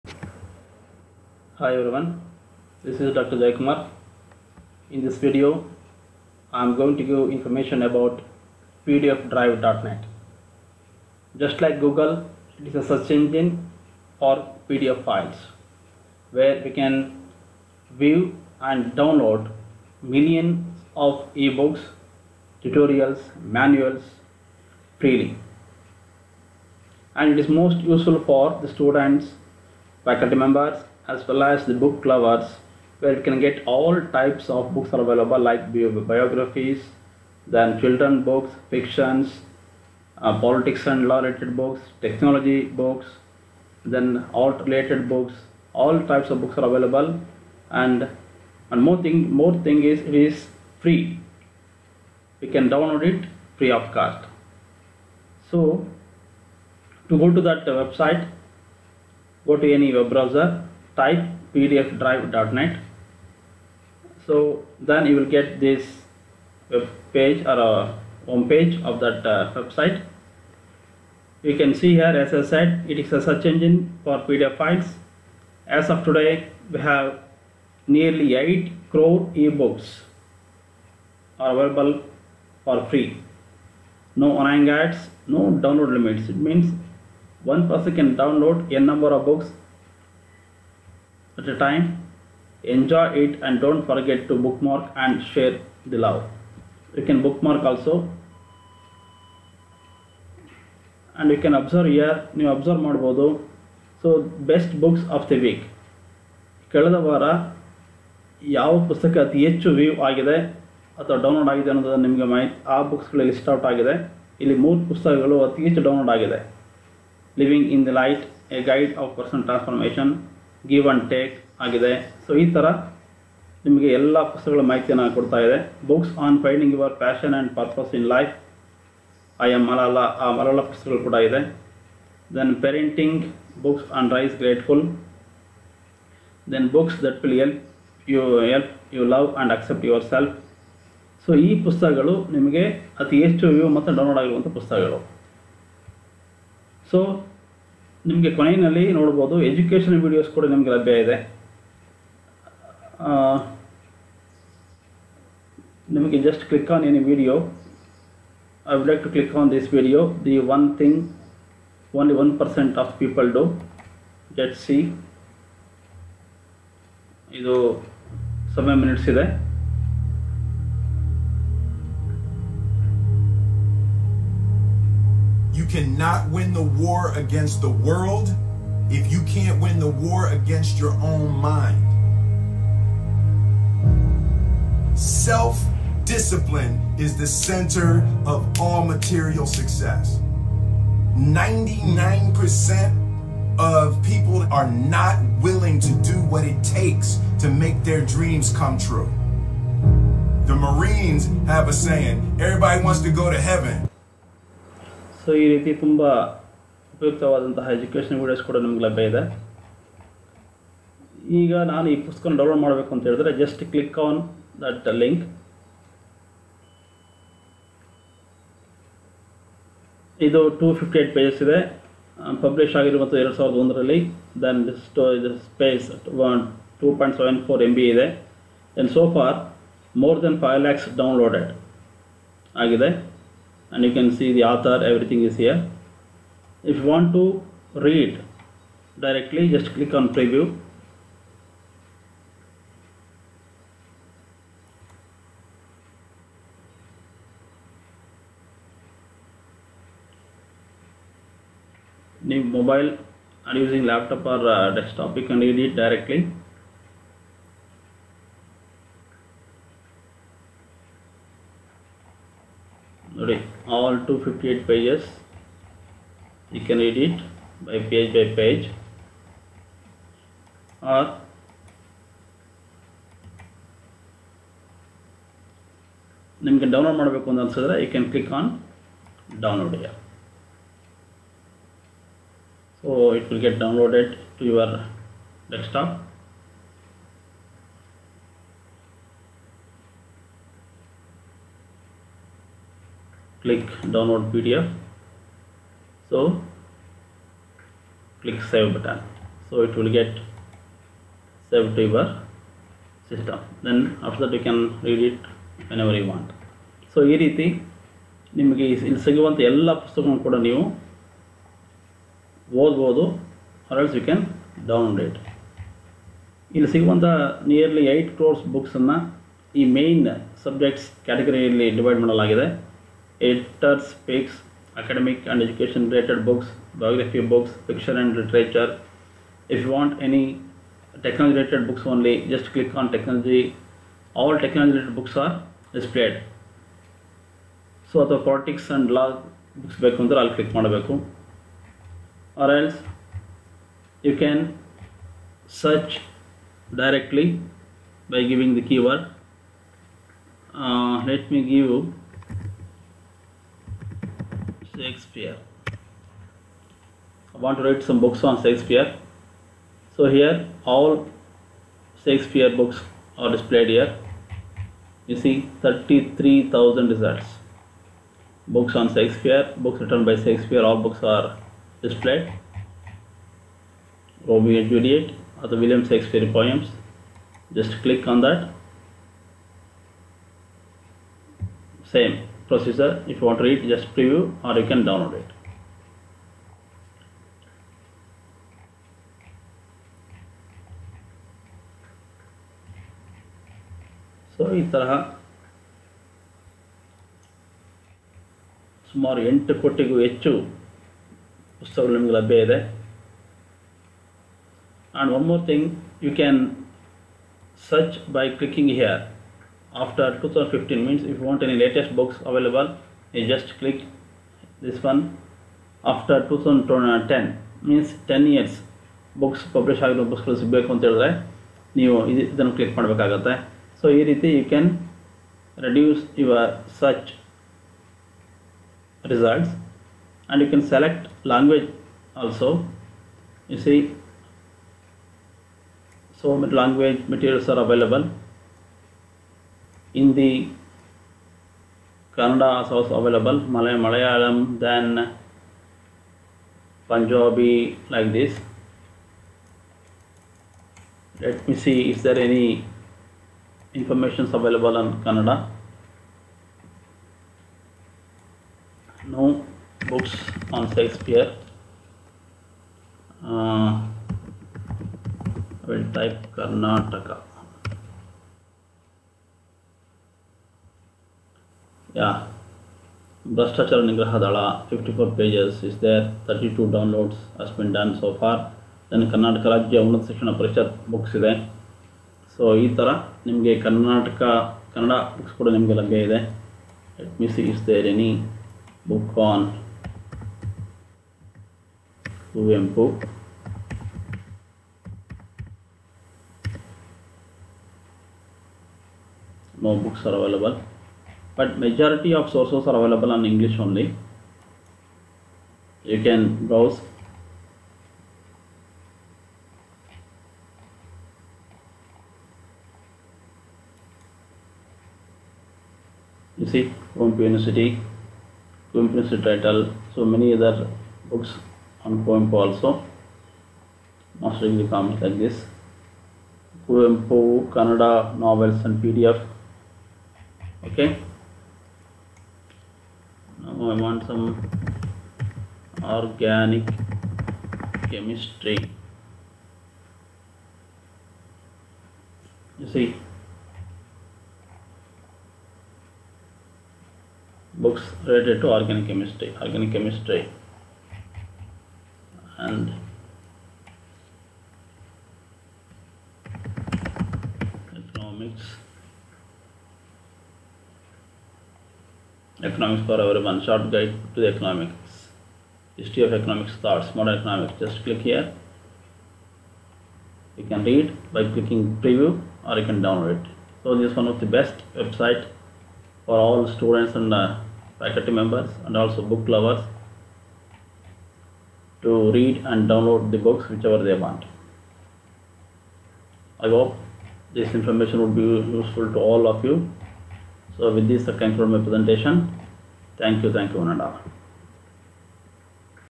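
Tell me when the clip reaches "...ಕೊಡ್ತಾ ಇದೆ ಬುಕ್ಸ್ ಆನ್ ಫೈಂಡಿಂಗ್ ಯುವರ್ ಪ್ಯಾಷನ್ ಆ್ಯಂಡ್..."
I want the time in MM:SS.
02:05.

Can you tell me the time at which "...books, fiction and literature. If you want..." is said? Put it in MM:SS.
05:27.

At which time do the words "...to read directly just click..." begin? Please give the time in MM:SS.
03:57.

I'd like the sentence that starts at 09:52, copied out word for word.
Thank you, thank you one and all.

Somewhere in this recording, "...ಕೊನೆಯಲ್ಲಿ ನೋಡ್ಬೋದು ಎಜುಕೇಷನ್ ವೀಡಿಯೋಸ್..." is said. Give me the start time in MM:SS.
02:28.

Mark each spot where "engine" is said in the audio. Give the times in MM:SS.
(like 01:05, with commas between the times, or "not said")
00:13, 01:13.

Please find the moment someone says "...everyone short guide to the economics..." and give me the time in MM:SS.
09:22.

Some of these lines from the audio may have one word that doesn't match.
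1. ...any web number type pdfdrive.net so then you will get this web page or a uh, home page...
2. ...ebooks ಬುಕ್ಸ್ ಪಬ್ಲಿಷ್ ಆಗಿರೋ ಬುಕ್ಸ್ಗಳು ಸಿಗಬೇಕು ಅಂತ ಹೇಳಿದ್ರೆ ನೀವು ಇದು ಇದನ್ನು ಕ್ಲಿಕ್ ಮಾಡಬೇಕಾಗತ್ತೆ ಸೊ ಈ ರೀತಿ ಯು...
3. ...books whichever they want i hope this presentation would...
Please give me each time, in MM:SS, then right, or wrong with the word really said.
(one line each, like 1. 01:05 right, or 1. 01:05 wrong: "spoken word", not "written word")
1. 00:59 wrong: "browser", not "number"
2. 06:59 wrong: "books", not "ebooks"
3. 09:43 wrong: "information", not "presentation".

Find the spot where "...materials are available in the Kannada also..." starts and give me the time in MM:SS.
07:17.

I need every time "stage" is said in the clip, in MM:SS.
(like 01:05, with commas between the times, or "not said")
not said.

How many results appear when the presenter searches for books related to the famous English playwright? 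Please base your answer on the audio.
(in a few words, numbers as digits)
33,000.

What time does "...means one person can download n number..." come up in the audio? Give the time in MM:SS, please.
01:26.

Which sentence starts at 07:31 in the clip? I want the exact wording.
Let me see is there any information available on Kannada.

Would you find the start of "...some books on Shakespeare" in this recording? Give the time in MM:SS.
05:57.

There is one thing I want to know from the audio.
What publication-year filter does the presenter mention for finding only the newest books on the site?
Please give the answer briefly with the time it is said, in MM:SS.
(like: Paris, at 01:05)
after 2015, at 06:49.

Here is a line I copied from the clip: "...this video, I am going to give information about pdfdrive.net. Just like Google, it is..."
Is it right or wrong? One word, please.
right.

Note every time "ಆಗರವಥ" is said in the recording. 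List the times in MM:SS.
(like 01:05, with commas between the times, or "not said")
02:24, 03:42.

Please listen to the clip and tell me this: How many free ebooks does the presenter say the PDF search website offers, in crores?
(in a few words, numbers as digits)
8 crore.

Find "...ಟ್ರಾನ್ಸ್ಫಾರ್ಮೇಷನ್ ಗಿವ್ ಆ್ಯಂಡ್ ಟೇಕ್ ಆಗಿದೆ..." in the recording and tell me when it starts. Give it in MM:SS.
01:59.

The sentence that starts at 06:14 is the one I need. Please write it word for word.
Romeo and Juliet are the William Shakespeare poems.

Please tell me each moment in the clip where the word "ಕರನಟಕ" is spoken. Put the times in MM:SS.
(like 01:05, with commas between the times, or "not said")
07:59, 08:03.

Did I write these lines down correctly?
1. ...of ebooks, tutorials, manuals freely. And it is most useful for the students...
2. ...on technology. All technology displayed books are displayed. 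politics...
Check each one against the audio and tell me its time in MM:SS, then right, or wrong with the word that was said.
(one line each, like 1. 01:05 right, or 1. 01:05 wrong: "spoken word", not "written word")
1. 00:20 right
2. 05:32 wrong: "related", not "displayed".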